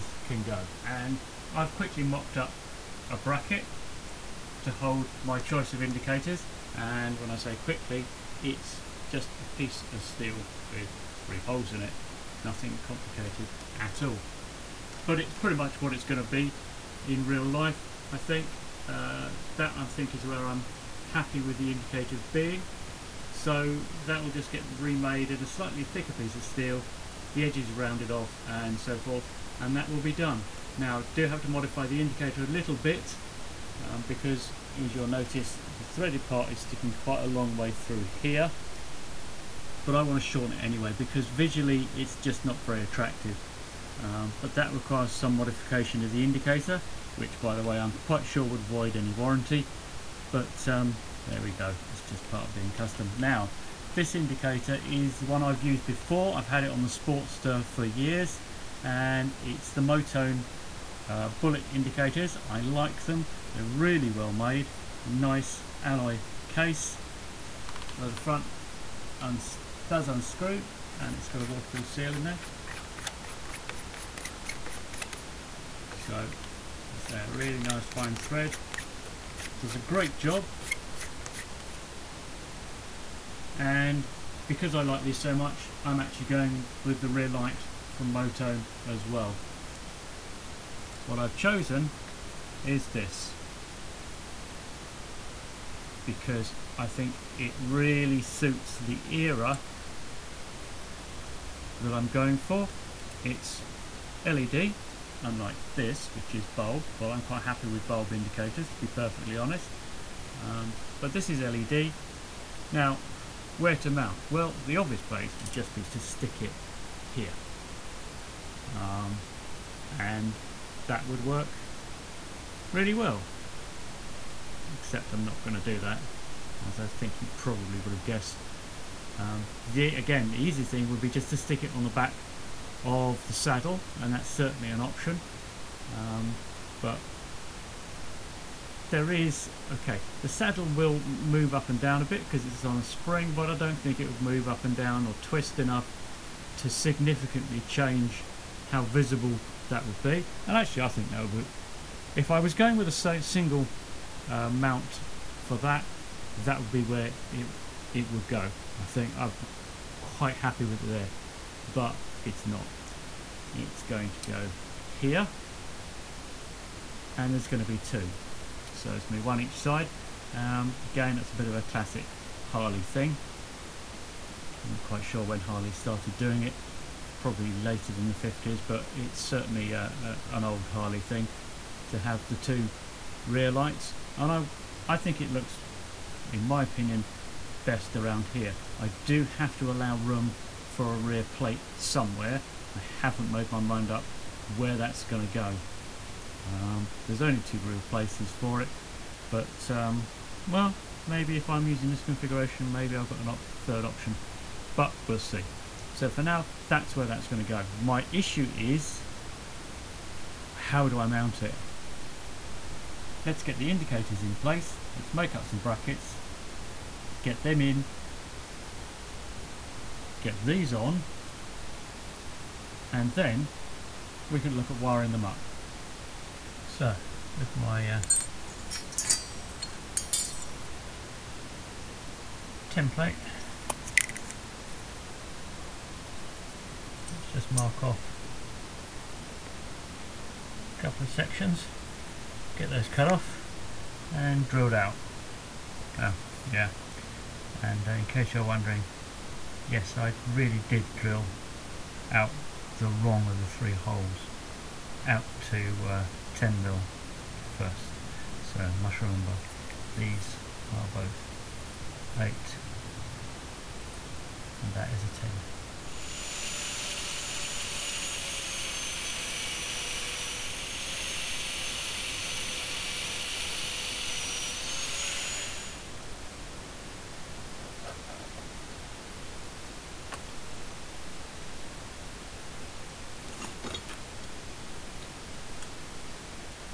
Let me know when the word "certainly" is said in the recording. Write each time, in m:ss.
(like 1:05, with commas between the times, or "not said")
2:14, 2:59.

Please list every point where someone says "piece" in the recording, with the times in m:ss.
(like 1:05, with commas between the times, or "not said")
0:09, 0:26.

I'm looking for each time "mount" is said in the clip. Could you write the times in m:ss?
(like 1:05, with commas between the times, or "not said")
1:53, 2:34, 3:31.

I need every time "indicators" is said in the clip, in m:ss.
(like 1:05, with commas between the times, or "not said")
0:05, 0:21, 0:31, 0:46, 0:54, 1:01, 1:48, 3:33.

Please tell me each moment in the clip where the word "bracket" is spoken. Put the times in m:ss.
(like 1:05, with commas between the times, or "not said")
0:03, 3:35.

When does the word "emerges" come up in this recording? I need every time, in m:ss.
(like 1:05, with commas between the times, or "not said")
not said.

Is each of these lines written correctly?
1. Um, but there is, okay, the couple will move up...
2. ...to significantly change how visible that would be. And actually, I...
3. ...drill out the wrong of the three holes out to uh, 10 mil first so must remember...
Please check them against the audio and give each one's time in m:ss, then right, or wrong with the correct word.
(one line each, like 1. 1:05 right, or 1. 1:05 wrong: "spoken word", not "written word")
1. 2:15 wrong: "saddle", not "couple"
2. 2:26 right
3. 4:10 right.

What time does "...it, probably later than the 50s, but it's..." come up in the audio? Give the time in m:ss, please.
2:56.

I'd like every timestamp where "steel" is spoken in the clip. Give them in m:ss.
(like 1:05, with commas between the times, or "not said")
0:10, 0:26.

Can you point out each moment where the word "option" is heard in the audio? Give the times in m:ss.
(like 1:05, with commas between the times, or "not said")
2:14, 3:23.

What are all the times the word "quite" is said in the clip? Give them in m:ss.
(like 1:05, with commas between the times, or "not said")
0:36, 0:48, 1:47, 2:39, 2:54.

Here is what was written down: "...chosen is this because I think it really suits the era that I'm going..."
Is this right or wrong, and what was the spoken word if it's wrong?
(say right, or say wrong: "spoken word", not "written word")
right.